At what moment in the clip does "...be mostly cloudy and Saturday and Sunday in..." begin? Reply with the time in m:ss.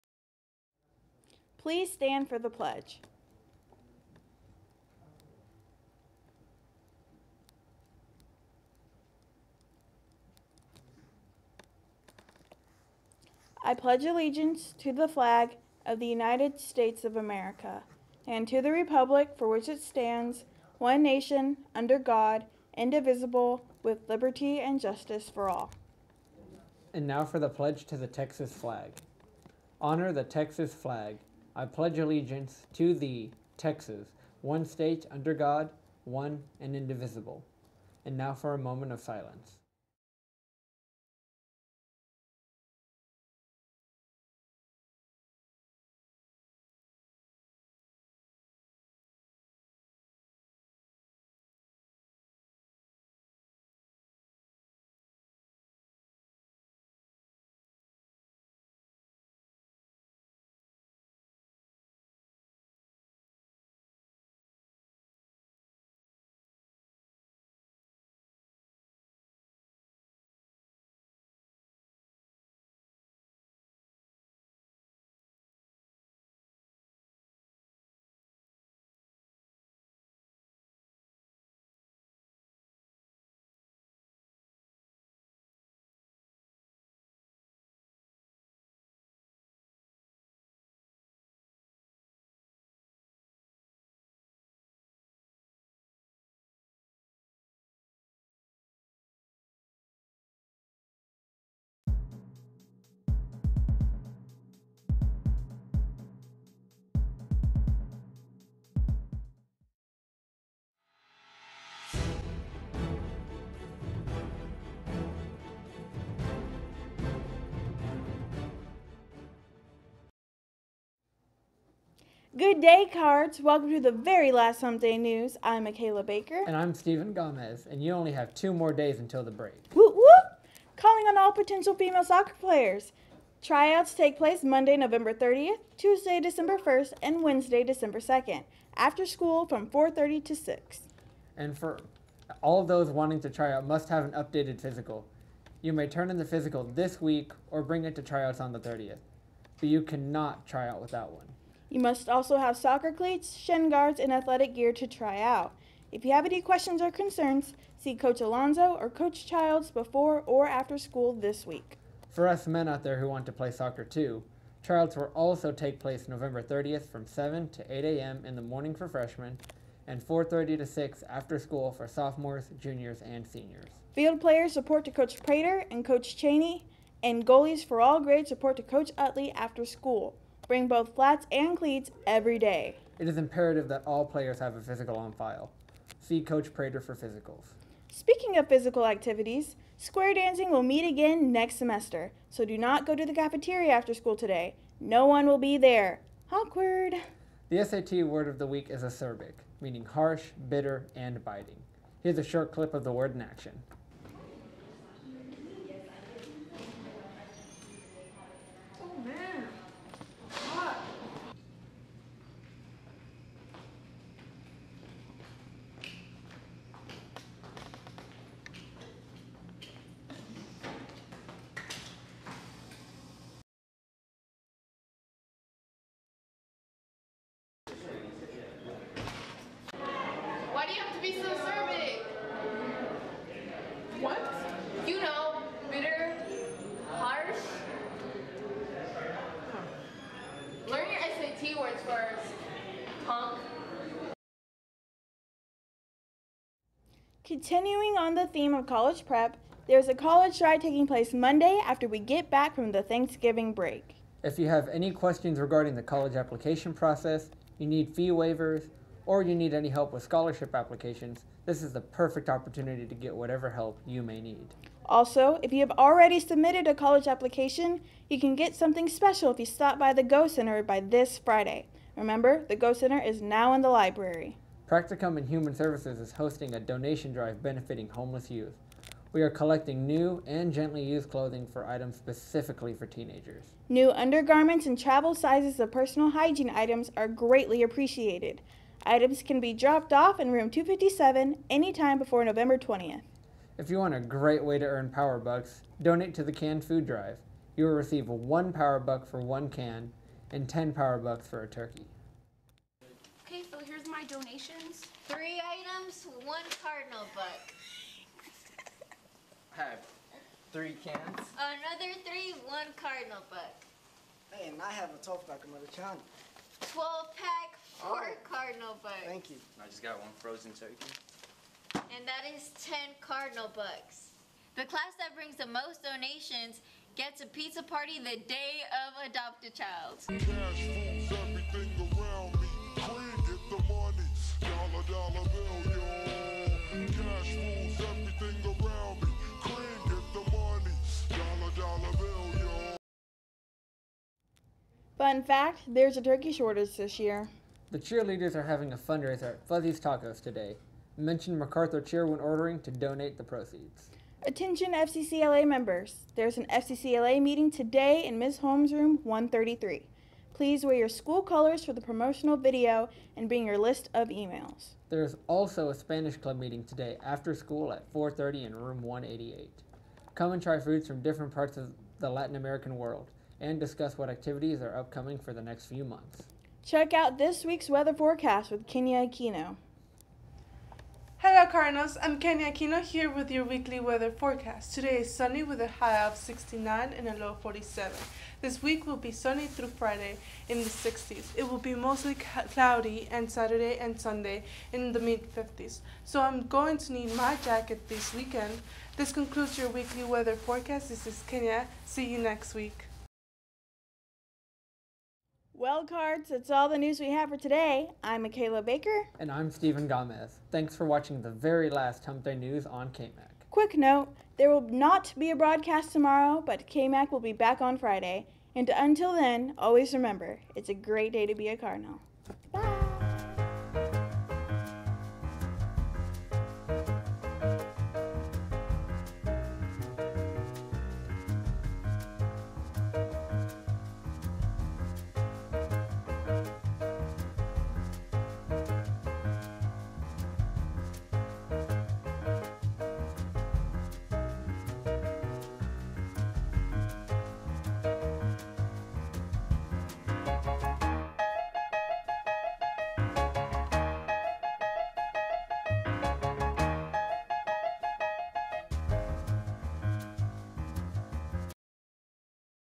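6:31.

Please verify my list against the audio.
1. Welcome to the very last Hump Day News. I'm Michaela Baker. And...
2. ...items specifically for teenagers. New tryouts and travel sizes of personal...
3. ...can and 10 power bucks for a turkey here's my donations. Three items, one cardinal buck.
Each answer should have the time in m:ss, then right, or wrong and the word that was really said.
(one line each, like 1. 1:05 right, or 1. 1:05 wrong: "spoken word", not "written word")
1. 2:03 right
2. 4:41 wrong: "undergarments", not "tryouts"
3. 4:59 right.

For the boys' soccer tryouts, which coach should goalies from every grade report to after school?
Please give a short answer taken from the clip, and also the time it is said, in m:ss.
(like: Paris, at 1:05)
Coach Utley, at 2:58.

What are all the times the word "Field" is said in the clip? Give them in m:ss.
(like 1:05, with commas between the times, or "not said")
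2:53.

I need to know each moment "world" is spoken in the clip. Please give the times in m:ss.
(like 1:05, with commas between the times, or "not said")
6:12.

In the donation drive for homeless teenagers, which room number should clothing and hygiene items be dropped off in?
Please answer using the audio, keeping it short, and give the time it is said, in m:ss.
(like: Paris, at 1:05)
257, at 4:50.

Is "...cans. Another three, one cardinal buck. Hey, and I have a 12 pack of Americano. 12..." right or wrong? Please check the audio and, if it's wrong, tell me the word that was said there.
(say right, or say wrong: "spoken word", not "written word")
right.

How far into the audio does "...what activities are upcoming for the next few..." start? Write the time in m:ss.
6:13.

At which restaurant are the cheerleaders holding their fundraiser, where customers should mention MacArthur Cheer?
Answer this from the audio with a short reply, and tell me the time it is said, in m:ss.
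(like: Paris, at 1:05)
Fuzzy's Tacos, at 5:49.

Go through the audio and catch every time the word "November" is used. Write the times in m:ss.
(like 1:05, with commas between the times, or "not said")
2:14, 2:46, 4:52.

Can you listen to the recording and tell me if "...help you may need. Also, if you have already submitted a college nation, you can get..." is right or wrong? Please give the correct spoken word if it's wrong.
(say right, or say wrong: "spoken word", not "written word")
wrong: "application", not "nation".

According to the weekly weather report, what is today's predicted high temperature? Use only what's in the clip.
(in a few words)
69.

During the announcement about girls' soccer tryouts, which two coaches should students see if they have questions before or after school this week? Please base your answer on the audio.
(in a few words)
Coach Alonzo or Coach Childs.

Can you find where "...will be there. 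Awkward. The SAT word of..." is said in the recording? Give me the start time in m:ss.
3:15.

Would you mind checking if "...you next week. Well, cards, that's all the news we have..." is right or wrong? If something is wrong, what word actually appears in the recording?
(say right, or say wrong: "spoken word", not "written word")
right.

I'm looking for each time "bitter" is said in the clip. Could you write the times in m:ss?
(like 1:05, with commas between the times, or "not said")
3:20.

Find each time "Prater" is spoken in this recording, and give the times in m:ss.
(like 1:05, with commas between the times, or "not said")
2:55, 3:06.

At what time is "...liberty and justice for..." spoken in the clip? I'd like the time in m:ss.
0:24.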